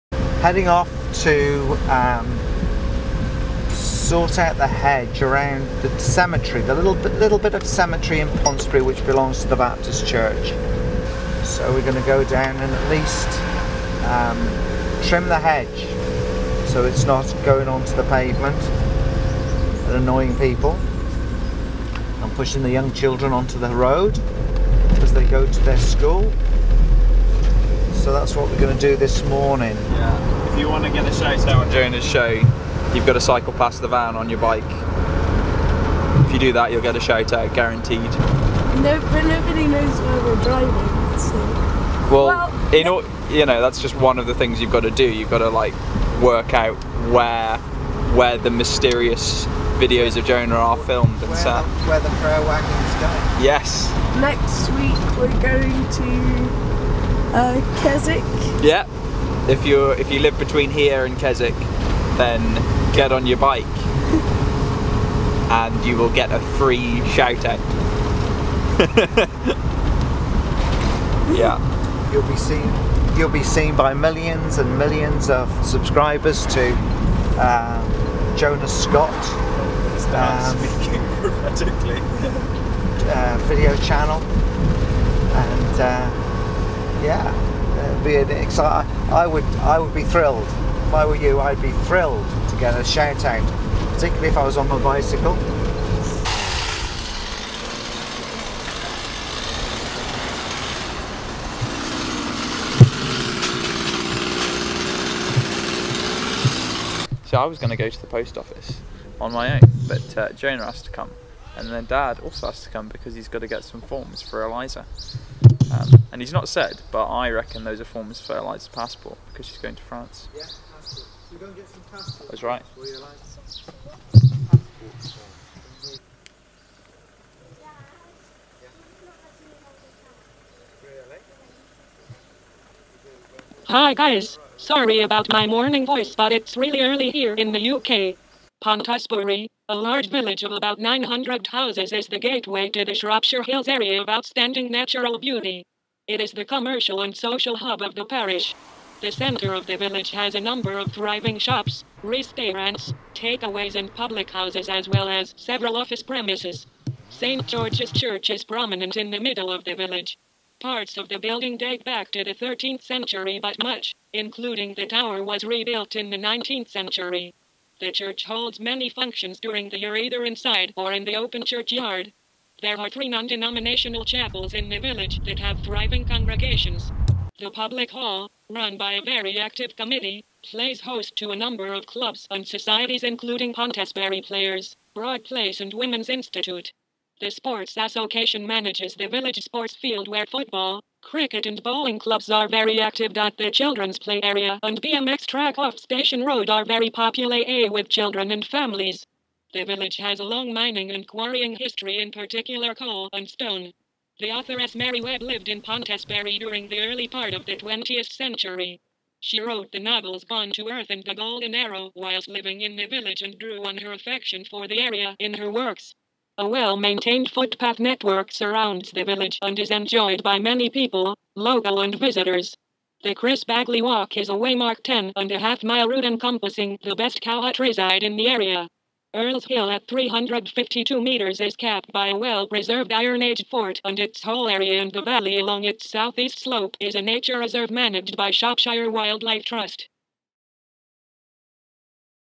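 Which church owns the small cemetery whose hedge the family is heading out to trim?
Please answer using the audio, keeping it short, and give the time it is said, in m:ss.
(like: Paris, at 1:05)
The Baptist Church, at 0:09.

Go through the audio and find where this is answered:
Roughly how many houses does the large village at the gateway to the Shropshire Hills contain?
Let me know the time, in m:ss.
2:20.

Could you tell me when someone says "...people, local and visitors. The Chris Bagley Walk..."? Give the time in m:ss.
3:40.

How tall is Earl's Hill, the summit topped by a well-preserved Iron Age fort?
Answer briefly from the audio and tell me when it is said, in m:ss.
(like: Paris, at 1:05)
352 meters, at 3:49.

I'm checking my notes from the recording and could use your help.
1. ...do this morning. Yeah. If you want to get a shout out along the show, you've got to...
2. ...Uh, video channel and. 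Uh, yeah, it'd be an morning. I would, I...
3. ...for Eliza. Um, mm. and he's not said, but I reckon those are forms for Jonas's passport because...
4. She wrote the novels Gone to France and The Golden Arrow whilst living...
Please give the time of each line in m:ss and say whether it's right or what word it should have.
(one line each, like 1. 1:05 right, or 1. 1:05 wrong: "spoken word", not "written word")
1. 0:28 wrong: "during", not "along"
2. 1:23 wrong: "exciting", not "morning"
3. 1:54 wrong: "Eliza", not "Jonas"
4. 3:29 wrong: "Earth", not "France".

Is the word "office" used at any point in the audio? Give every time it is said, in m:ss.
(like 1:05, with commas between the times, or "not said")
1:48, 2:35.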